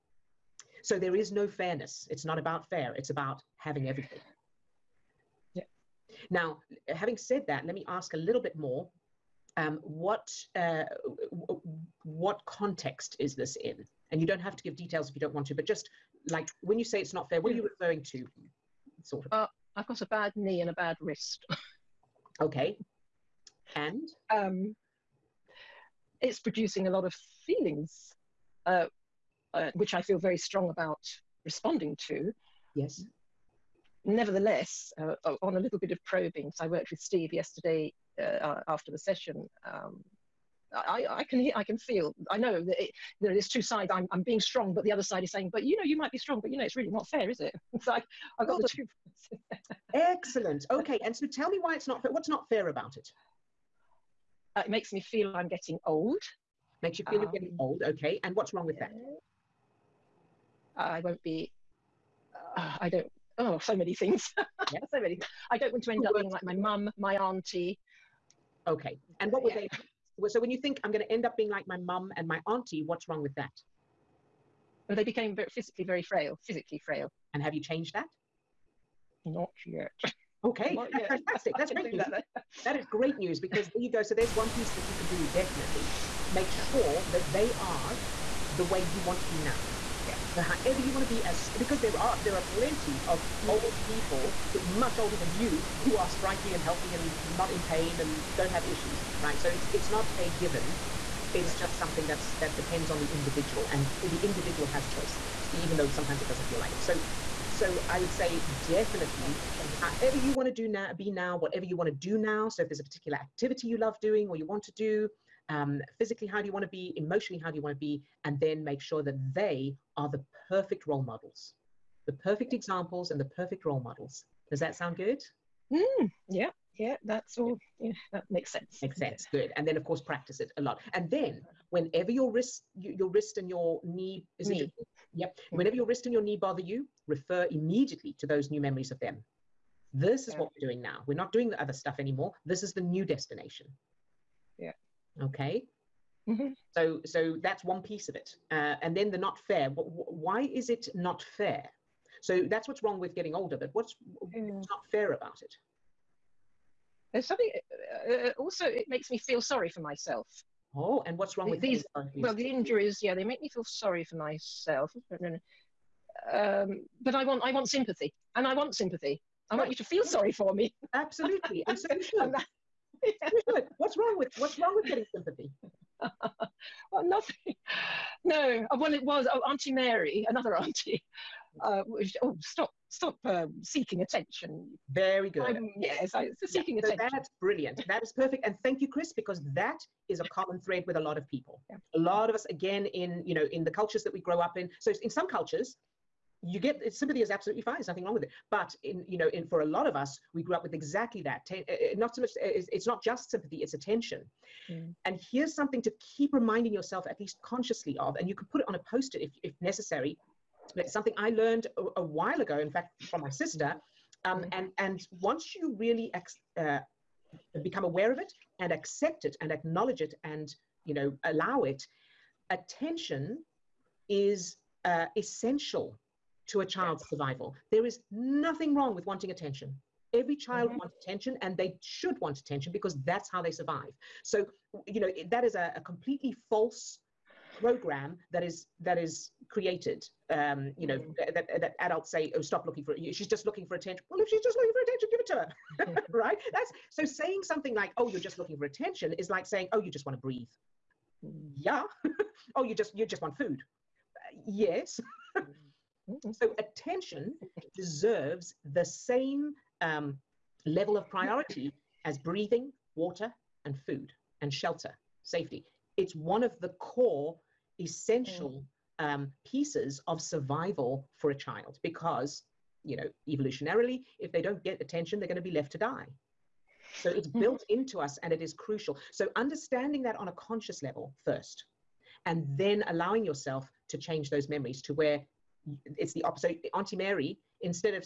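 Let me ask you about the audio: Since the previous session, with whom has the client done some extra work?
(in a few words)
Steve.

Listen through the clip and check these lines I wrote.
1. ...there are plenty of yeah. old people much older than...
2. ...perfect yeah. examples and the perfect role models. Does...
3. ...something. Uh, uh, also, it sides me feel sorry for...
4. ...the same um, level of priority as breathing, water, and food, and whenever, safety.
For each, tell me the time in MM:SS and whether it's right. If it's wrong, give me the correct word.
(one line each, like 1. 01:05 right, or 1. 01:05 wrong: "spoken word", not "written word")
1. 01:32 right
2. 02:02 right
3. 02:37 wrong: "makes", not "sides"
4. 04:18 wrong: "shelter", not "whenever".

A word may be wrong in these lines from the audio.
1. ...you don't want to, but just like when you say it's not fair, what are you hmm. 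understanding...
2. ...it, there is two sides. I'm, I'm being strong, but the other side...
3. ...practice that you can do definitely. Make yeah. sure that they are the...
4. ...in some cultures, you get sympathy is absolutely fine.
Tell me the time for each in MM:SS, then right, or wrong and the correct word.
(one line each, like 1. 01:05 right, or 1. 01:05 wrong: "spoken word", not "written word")
1. 00:15 wrong: "referring", not "understanding"
2. 00:42 right
3. 01:24 wrong: "piece", not "practice"
4. 03:15 right.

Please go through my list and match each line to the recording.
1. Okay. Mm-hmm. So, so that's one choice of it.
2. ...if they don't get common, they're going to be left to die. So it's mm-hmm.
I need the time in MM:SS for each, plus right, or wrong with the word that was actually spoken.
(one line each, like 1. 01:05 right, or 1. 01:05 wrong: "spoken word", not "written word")
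1. 02:25 wrong: "piece", not "choice"
2. 04:34 wrong: "attention", not "common".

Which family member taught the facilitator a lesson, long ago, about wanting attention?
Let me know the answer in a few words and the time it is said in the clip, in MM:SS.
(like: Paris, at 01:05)
Sister, at 03:33.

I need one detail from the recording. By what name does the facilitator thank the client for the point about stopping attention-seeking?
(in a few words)
Chris.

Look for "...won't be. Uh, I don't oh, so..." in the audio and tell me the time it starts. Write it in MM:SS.
01:00.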